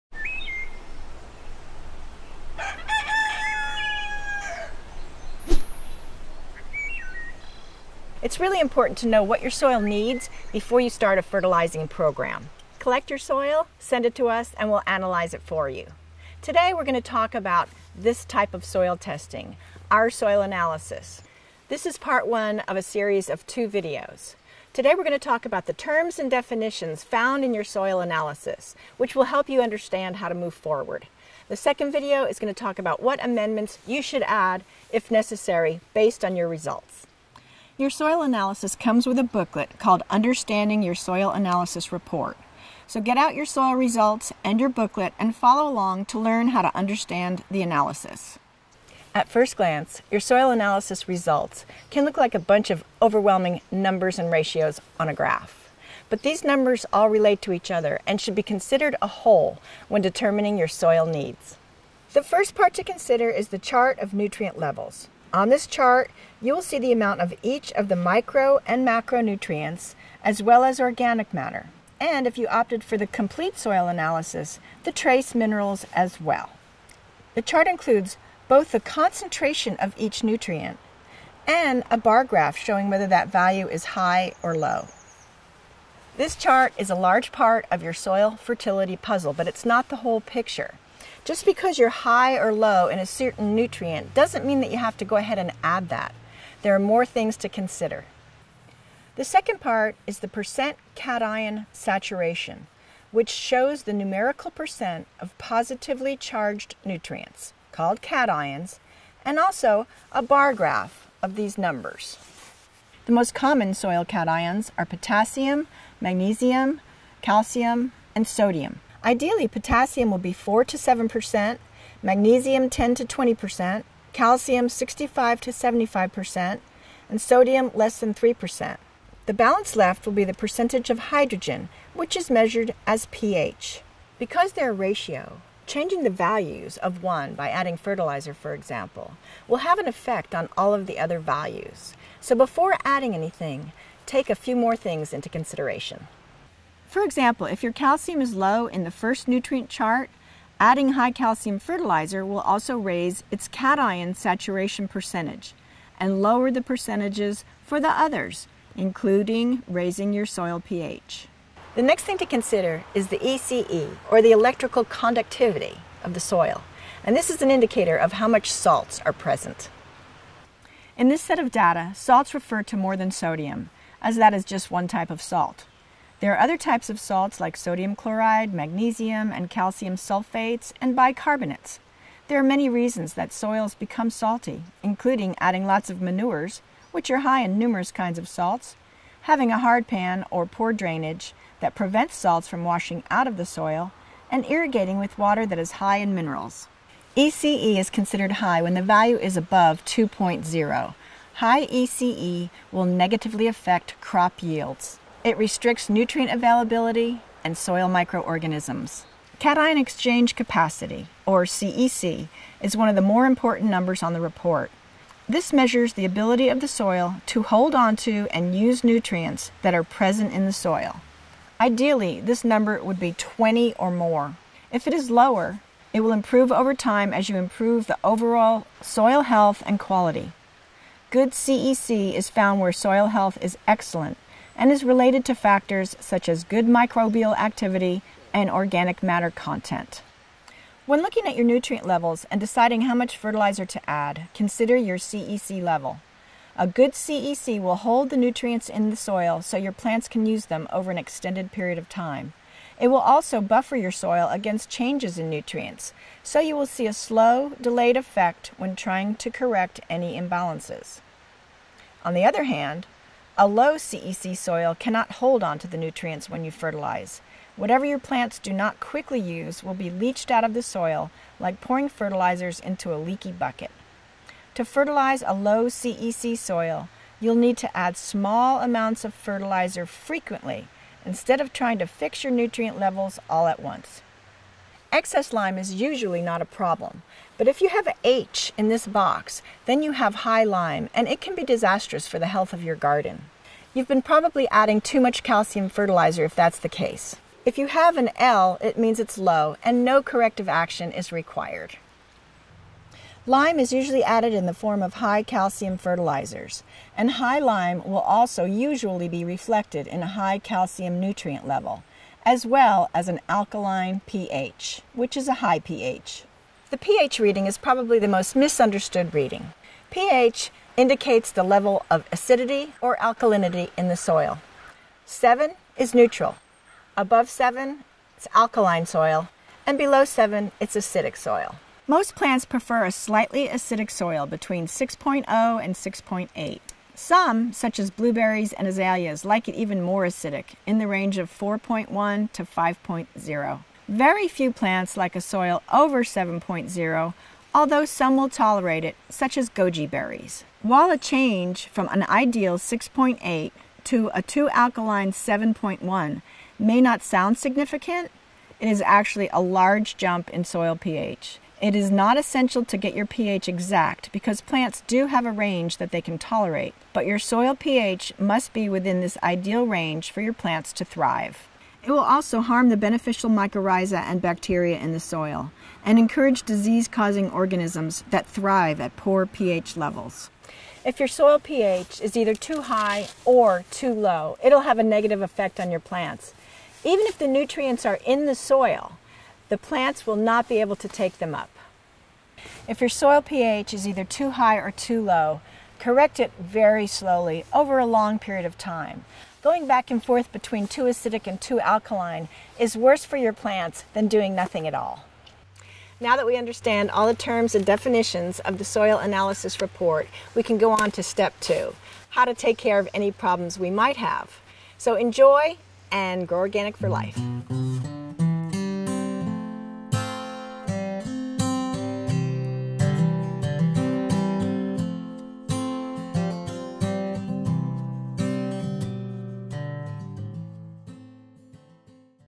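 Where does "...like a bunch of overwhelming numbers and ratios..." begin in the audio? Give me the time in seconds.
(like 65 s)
52 s.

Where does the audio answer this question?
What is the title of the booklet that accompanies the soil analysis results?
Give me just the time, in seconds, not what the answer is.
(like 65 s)
40 s.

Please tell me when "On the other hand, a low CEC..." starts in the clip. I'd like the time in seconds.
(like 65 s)
262 s.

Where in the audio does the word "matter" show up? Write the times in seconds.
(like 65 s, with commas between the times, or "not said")
71 s, 239 s.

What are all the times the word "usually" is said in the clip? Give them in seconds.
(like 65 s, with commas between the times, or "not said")
285 s, 303 s, 308 s.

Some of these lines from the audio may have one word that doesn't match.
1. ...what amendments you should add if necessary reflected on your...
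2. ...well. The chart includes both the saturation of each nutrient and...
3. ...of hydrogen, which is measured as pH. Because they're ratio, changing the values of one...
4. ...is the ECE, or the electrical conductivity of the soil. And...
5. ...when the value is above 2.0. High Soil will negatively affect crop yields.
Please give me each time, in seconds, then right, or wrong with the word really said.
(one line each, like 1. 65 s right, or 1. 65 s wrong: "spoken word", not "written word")
1. 33 s wrong: "based", not "reflected"
2. 76 s wrong: "concentration", not "saturation"
3. 130 s right
4. 162 s right
5. 198 s wrong: "ECE", not "Soil".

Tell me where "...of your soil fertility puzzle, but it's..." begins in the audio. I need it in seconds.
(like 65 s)
87 s.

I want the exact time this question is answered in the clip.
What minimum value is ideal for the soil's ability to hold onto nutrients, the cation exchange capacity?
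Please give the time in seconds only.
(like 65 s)
223 s.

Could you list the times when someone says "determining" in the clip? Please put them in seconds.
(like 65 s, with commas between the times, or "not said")
60 s.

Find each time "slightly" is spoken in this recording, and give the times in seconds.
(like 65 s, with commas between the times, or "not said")
332 s.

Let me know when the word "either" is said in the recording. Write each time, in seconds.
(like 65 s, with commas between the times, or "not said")
382 s, 393 s.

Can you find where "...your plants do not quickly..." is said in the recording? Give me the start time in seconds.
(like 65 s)
267 s.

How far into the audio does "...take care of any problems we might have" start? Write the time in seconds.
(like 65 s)
412 s.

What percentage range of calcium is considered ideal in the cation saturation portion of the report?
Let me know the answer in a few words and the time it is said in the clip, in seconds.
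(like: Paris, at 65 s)
65 to 75%, at 124 s.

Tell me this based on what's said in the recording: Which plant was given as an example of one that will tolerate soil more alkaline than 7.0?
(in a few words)
goji berries.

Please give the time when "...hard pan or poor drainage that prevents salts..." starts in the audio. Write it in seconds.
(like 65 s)
189 s.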